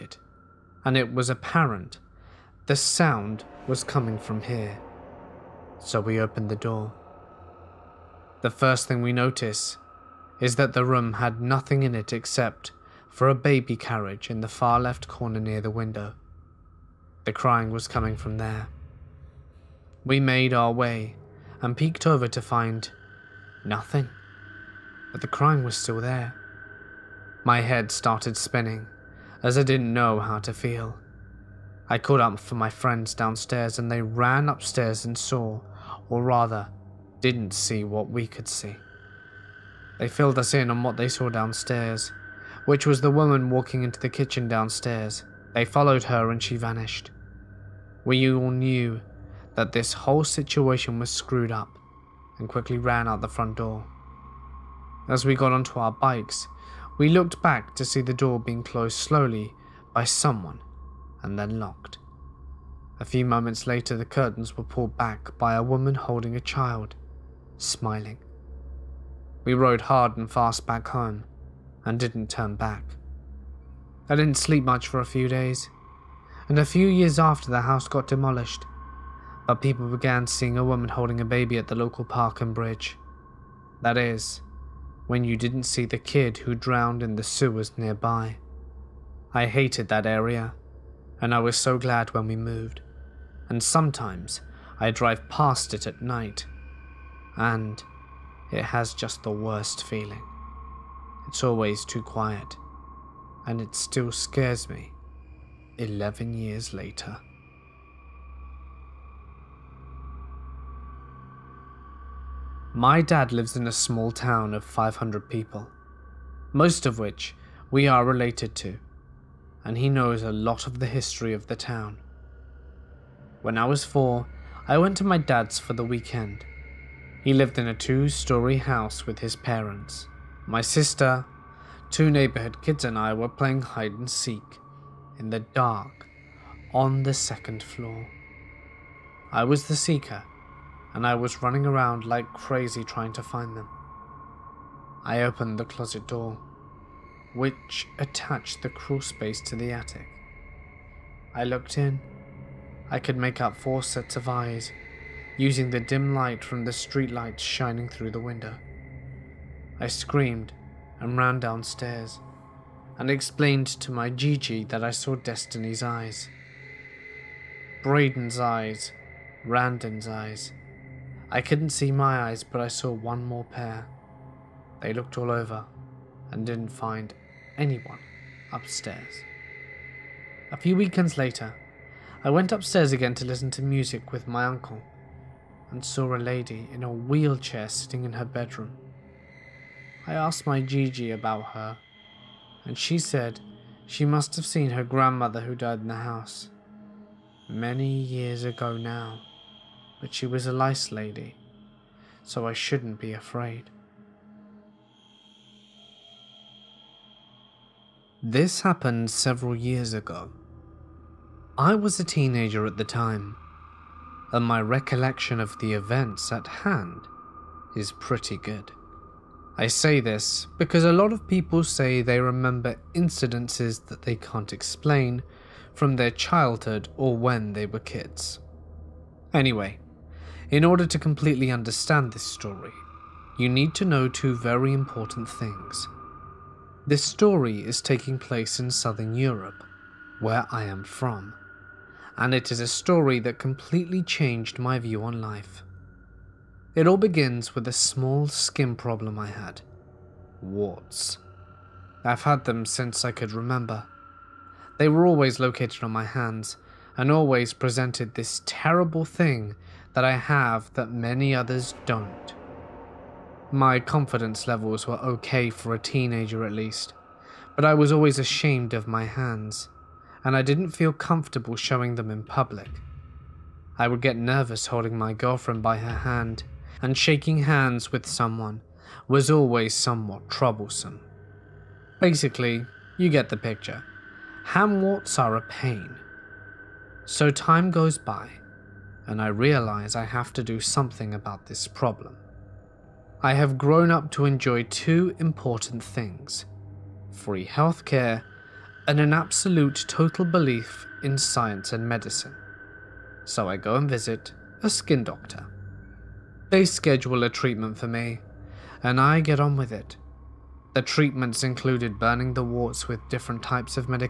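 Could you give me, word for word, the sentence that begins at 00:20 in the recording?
We made our way and peeked over to find nothing, but the crying was still there.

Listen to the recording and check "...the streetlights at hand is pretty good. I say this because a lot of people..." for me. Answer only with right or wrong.
wrong.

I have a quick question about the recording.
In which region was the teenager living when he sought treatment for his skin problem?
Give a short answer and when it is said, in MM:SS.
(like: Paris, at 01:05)
southern Europe, at 03:58.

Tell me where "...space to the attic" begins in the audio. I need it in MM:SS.
02:29.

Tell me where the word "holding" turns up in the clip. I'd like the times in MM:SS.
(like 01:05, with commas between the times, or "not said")
01:05, 01:20, 04:34.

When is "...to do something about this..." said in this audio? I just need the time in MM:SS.
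04:50.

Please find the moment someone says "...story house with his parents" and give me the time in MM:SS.
02:08.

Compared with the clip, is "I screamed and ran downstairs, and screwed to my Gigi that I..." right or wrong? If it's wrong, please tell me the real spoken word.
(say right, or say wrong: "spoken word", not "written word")
wrong: "explained", not "screwed".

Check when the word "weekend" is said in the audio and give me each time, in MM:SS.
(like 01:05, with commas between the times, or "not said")
02:05, 03:00.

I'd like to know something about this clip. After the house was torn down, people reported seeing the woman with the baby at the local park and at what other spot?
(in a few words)
bridge.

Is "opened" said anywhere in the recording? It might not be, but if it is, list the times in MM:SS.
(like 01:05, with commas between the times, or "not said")
00:06, 02:25.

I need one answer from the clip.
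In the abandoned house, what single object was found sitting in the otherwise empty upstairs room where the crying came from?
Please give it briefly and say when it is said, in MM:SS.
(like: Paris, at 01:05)
a baby carriage, at 00:13.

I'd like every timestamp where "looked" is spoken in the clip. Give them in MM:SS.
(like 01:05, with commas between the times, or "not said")
00:57, 02:31, 02:54.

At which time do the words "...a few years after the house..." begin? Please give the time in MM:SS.
01:16.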